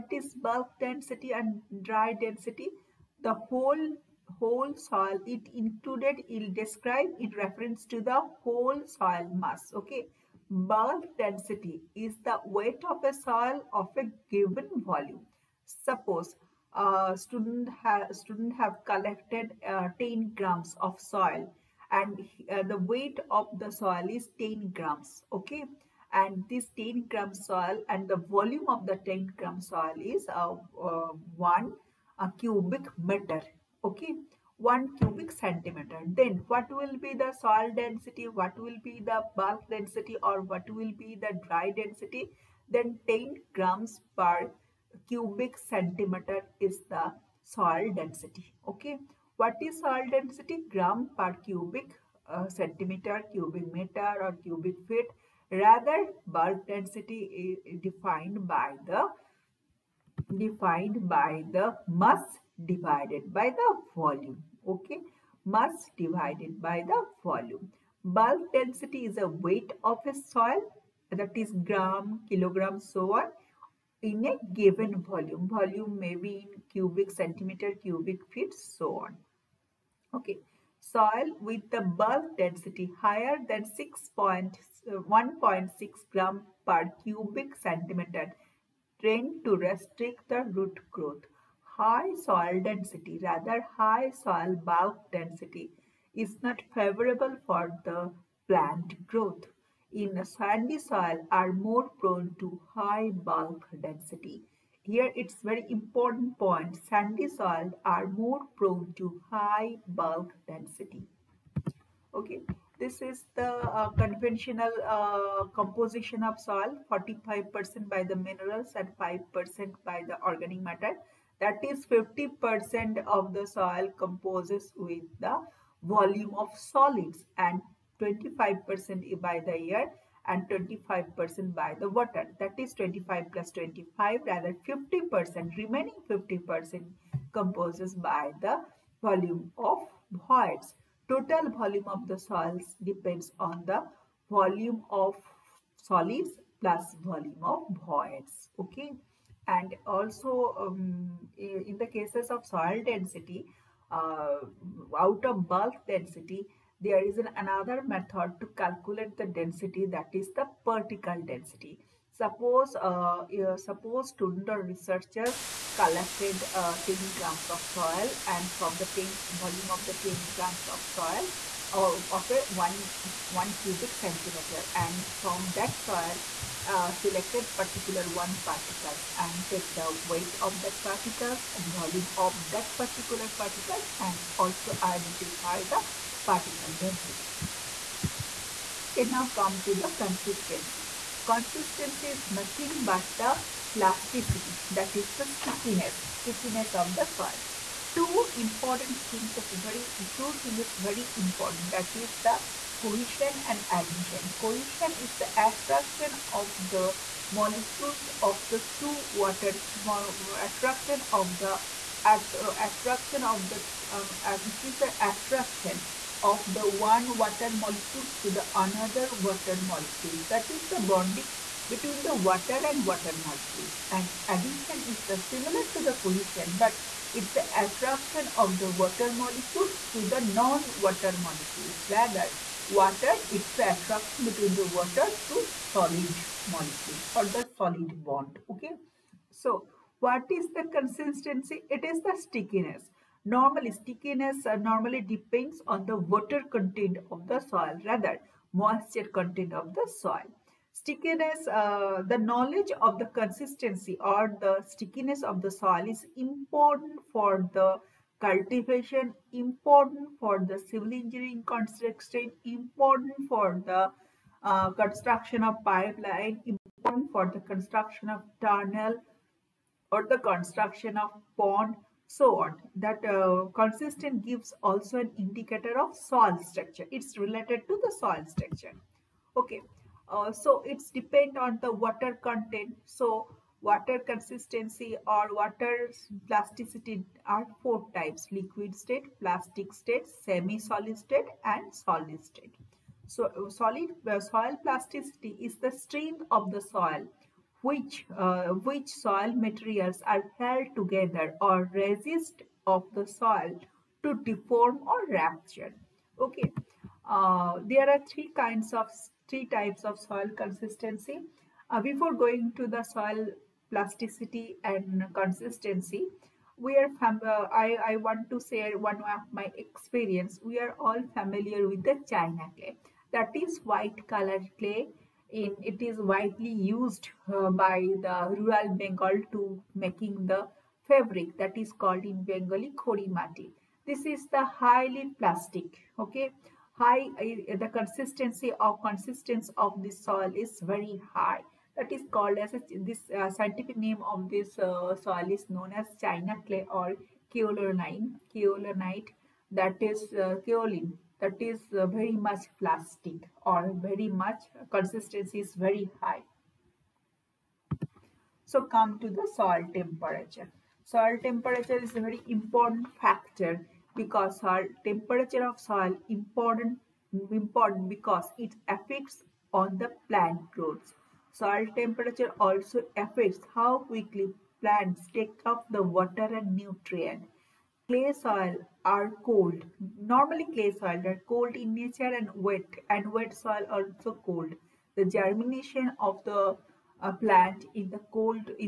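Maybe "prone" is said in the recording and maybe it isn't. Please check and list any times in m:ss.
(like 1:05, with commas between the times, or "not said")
1:41, 1:48.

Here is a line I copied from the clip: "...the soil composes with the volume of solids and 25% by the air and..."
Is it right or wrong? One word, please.
right.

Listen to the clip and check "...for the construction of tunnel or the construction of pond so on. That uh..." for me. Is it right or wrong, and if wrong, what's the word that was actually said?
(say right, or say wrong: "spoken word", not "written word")
right.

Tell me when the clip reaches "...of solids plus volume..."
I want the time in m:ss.
2:24.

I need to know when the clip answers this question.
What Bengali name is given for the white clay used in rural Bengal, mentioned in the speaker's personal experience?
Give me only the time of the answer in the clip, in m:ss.
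5:32.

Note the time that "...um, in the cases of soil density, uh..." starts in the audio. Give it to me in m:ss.
2:30.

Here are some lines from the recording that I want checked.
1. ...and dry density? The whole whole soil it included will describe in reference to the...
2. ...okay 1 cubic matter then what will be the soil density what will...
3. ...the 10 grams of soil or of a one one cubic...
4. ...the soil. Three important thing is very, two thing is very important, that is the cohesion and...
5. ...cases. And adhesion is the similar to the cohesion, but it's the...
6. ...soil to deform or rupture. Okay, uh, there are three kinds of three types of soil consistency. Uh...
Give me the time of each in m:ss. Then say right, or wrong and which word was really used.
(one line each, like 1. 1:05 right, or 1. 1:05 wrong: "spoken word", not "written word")
1. 0:01 right
2. 0:33 wrong: "centimeter", not "matter"
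3. 2:49 right
4. 3:16 wrong: "Two", not "Three"
5. 3:43 wrong: "molecules", not "cases"
6. 5:03 right.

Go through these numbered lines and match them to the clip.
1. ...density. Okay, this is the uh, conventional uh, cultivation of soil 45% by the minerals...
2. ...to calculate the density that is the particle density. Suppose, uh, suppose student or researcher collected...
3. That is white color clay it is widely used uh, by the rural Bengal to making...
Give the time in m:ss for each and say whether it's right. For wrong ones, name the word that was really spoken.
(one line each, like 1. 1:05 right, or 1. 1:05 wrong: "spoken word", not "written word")
1. 1:50 wrong: "composition", not "cultivation"
2. 2:38 right
3. 5:23 right.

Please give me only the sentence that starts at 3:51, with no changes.
Rather, water, it's the attraction between the water to solid molecules or the solid bond.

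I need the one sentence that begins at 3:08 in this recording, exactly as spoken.
Okay, now come to the consistency.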